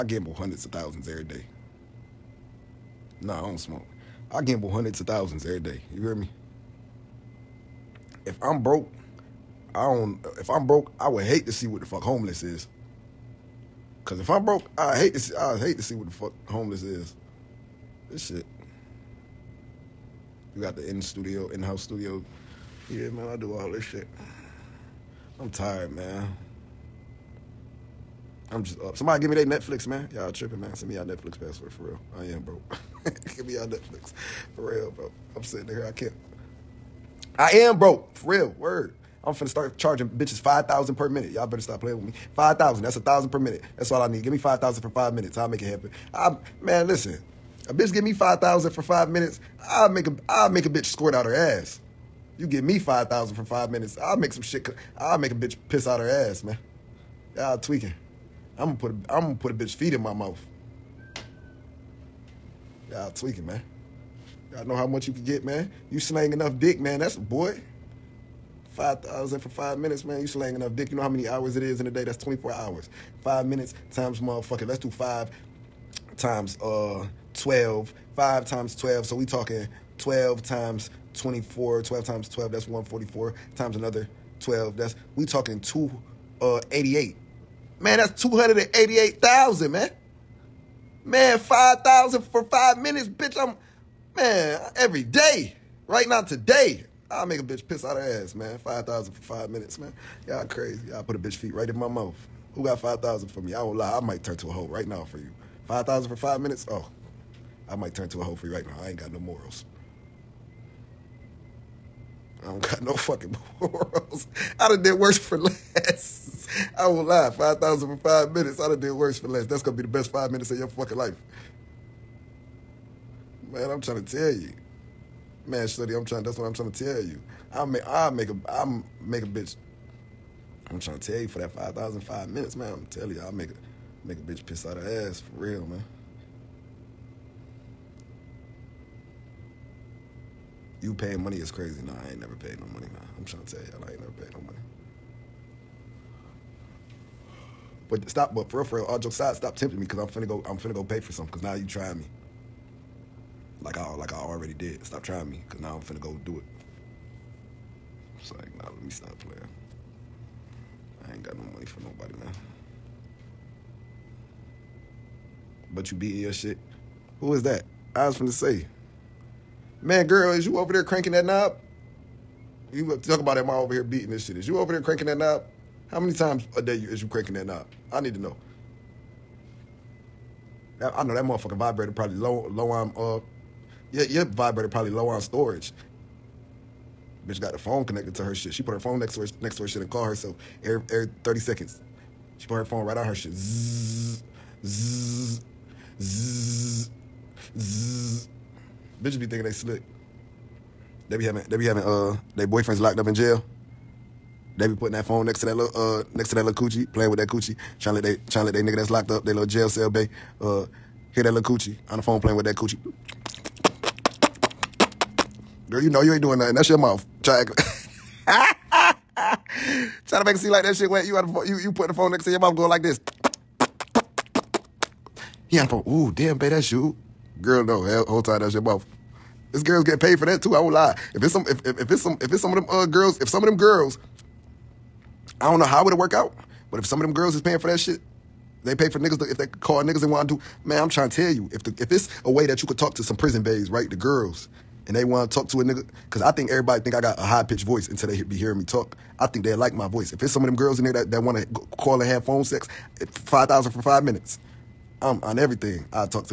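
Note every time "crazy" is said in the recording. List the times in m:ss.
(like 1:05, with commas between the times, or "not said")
1:40, 2:21.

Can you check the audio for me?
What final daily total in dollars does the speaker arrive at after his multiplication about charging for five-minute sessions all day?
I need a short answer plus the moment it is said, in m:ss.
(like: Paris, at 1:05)
288,000, at 1:28.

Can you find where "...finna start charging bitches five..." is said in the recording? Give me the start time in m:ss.
0:39.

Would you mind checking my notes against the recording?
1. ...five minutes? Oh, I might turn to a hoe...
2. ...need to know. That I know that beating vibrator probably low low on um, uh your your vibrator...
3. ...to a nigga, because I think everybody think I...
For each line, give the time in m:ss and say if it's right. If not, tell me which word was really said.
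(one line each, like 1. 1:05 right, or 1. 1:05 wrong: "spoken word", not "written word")
1. 1:46 right
2. 2:57 wrong: "motherfucking", not "beating"
3. 4:05 right.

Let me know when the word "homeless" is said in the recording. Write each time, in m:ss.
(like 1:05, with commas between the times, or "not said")
0:12, 0:16.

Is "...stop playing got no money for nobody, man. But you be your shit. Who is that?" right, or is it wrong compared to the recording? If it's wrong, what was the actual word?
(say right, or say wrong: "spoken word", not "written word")
right.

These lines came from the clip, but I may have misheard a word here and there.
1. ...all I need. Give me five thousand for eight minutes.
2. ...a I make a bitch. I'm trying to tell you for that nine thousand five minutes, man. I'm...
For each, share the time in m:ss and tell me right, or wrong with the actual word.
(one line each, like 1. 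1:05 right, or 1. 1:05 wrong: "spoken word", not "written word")
1. 0:43 wrong: "five", not "eight"
2. 2:08 wrong: "five", not "nine".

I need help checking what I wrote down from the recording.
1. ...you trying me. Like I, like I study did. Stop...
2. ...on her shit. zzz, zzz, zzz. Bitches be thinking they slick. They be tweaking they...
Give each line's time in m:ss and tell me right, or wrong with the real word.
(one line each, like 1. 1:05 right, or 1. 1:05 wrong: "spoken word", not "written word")
1. 2:31 wrong: "already", not "study"
2. 3:12 wrong: "having", not "tweaking".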